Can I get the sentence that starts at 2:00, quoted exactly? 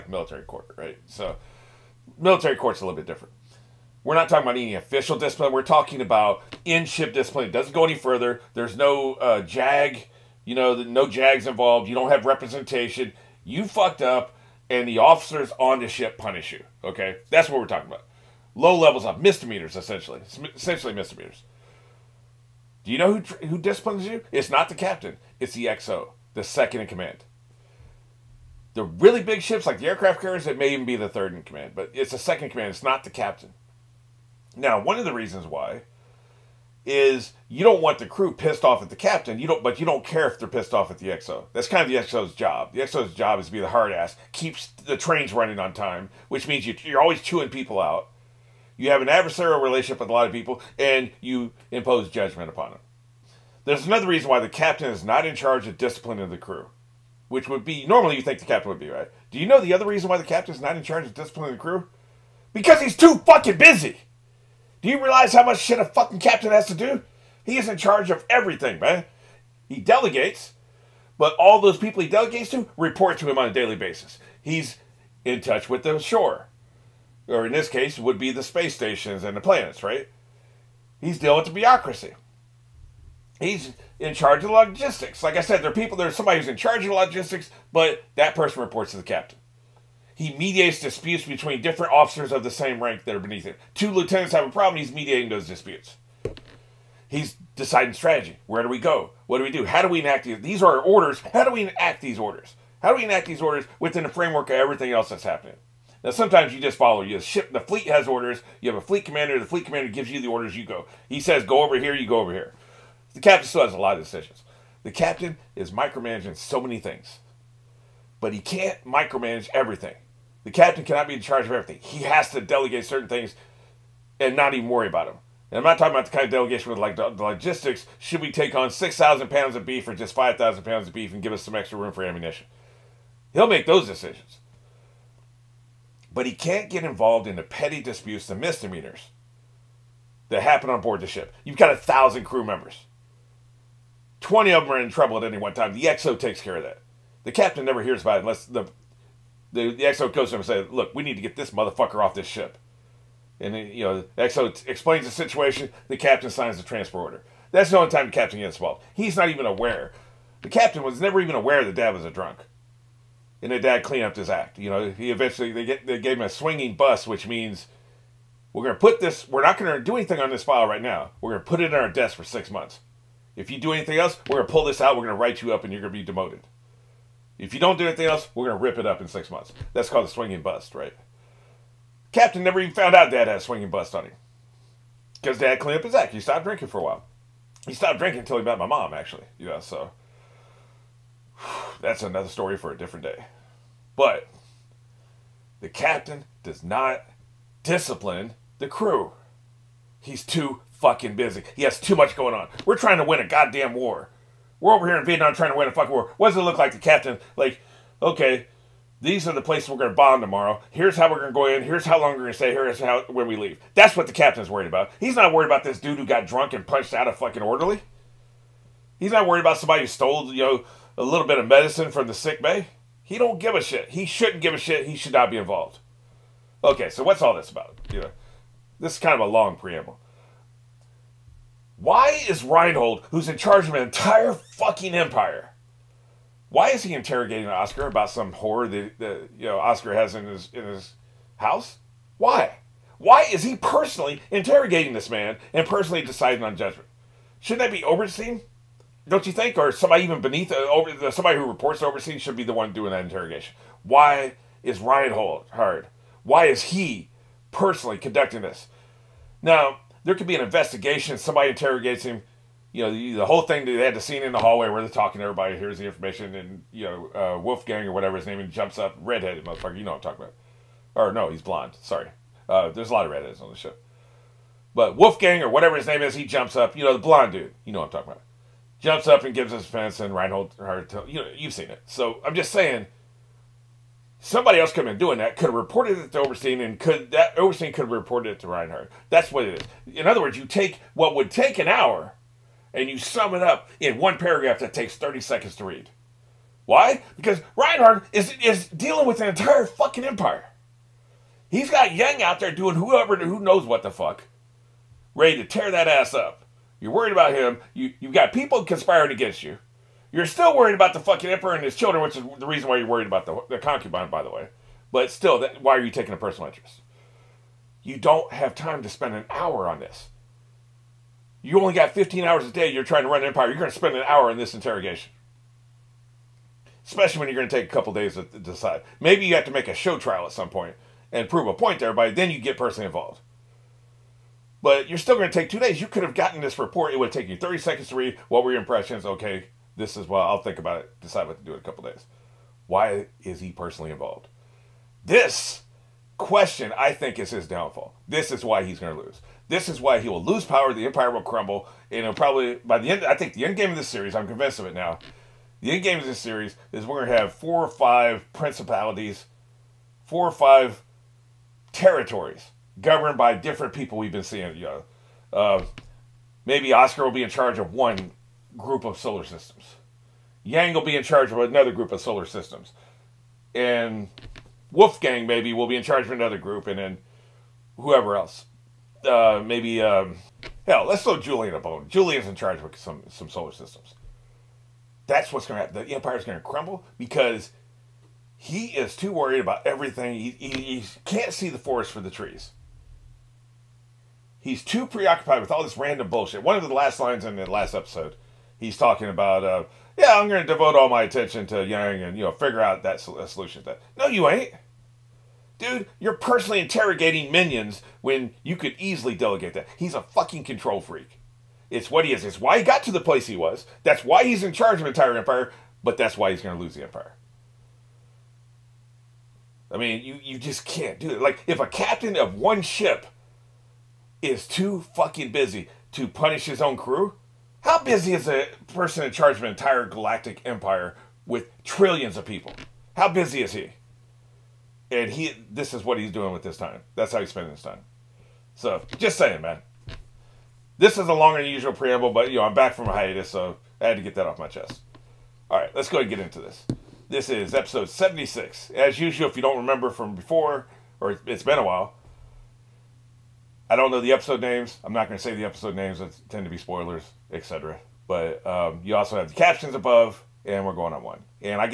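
The captain cannot be in charge of everything.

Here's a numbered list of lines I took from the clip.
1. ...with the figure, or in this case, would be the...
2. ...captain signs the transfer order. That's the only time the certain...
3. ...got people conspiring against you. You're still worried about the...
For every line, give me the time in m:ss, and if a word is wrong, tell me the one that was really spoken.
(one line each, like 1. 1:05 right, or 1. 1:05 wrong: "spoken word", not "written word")
1. 1:15 wrong: "shore", not "figure"
2. 2:35 wrong: "captain", not "certain"
3. 5:08 right.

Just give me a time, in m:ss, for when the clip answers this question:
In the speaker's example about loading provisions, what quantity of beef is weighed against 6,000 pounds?
2:10.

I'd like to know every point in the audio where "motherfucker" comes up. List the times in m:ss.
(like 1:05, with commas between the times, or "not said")
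2:31, 4:29.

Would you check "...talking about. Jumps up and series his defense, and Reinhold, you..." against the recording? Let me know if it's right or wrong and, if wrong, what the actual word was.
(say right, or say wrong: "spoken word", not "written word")
wrong: "gives", not "series".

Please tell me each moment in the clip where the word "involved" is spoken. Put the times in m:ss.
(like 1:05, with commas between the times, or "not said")
0:11, 2:16, 2:38, 3:45, 5:32, 5:43.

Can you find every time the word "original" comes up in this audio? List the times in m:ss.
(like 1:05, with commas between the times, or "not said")
not said.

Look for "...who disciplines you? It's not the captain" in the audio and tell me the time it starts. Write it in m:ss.
0:23.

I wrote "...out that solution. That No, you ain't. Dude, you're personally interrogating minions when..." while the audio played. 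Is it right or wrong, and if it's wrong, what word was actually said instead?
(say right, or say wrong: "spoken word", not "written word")
right.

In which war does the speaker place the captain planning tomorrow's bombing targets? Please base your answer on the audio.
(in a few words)
Vietnam.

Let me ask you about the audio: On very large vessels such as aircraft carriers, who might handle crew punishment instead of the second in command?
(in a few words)
Third in command.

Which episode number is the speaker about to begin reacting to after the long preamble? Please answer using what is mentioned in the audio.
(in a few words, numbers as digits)
76.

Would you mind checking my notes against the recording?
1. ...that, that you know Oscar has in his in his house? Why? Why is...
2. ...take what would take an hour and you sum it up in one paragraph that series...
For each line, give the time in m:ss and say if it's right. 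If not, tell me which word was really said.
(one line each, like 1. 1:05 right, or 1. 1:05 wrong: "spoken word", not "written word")
1. 3:58 right
2. 4:50 wrong: "takes", not "series".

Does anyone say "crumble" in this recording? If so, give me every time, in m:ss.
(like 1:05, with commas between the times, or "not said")
5:51, 6:26.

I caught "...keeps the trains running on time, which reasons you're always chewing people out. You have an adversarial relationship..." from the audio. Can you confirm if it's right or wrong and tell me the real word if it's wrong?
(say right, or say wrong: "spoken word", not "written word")
wrong: "means", not "reasons".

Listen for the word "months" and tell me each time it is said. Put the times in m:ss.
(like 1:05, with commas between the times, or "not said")
2:52, 2:59.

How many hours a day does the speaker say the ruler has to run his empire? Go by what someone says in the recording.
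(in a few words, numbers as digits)
15.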